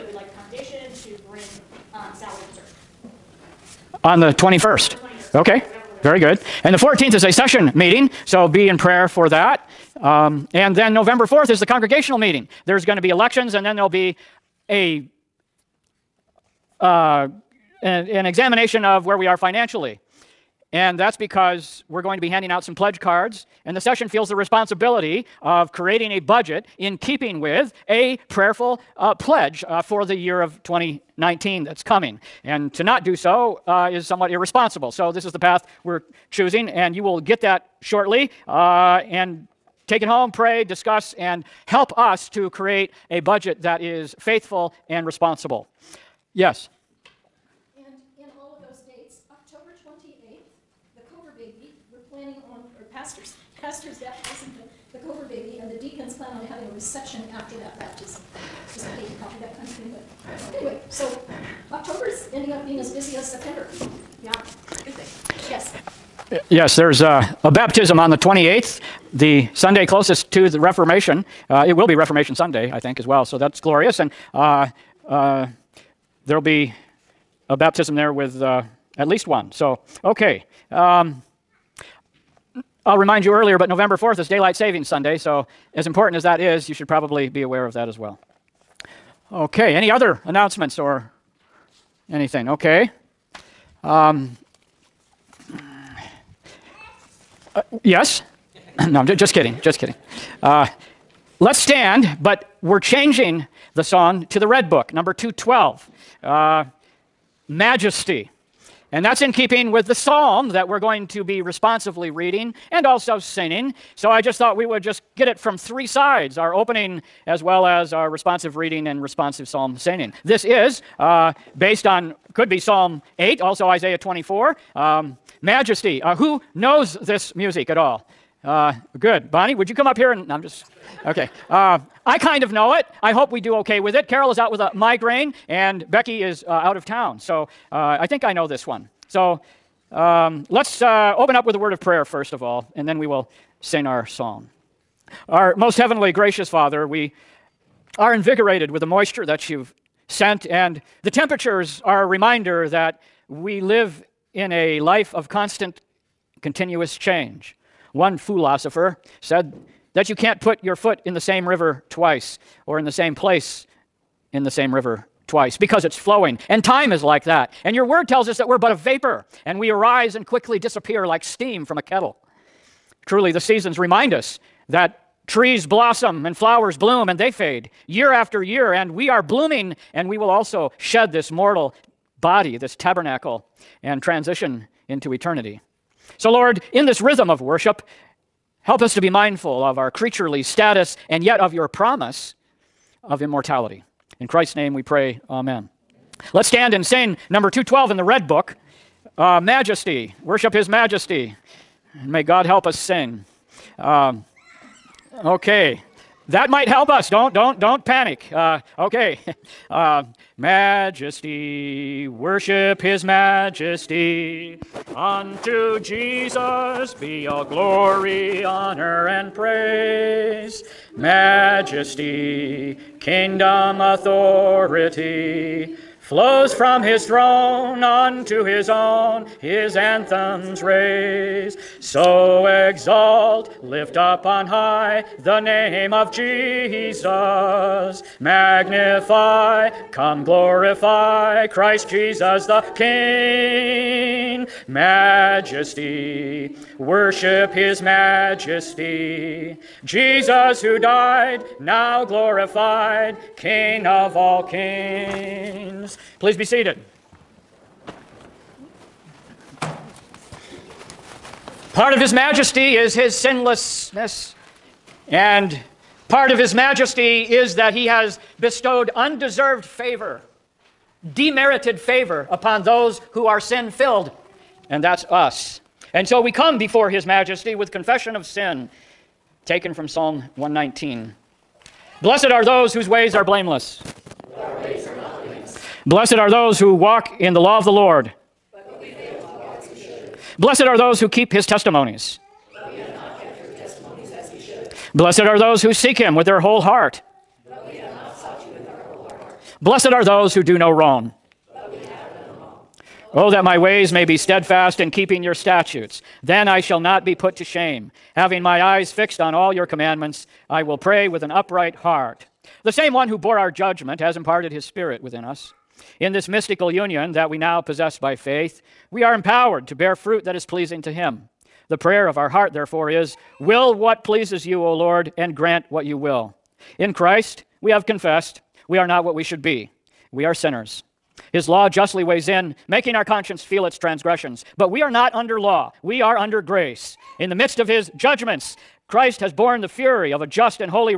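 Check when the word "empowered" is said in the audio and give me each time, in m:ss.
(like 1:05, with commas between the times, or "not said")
5:19.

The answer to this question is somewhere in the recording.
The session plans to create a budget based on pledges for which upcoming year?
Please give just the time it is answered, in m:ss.
0:30.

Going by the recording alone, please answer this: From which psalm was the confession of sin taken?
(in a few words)
Psalm 119.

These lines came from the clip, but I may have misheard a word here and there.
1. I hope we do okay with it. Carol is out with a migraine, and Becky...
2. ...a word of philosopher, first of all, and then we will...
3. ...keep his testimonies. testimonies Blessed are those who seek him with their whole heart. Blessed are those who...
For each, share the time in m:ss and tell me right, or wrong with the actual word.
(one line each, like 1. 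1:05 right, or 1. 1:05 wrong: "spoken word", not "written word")
1. 2:13 right
2. 2:21 wrong: "prayer", not "philosopher"
3. 4:51 right.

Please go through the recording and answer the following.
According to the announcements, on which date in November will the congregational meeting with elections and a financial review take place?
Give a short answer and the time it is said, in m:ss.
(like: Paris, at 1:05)
November 4th, at 0:10.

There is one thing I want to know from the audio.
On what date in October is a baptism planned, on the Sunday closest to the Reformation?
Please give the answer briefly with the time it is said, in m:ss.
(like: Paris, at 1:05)
28th, at 1:08.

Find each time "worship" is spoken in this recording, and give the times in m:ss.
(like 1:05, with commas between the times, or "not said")
3:07, 3:20, 3:32, 4:06.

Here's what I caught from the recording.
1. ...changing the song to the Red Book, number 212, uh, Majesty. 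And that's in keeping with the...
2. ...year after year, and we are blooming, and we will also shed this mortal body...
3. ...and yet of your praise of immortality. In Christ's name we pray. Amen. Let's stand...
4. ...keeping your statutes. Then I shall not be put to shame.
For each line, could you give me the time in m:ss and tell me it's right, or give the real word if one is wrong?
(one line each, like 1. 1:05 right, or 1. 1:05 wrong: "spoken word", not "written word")
1. 1:42 right
2. 2:57 right
3. 3:11 wrong: "promise", not "praise"
4. 5:04 right.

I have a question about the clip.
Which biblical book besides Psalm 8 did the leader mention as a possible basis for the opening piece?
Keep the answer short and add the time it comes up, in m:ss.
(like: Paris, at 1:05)
Isaiah, at 2:03.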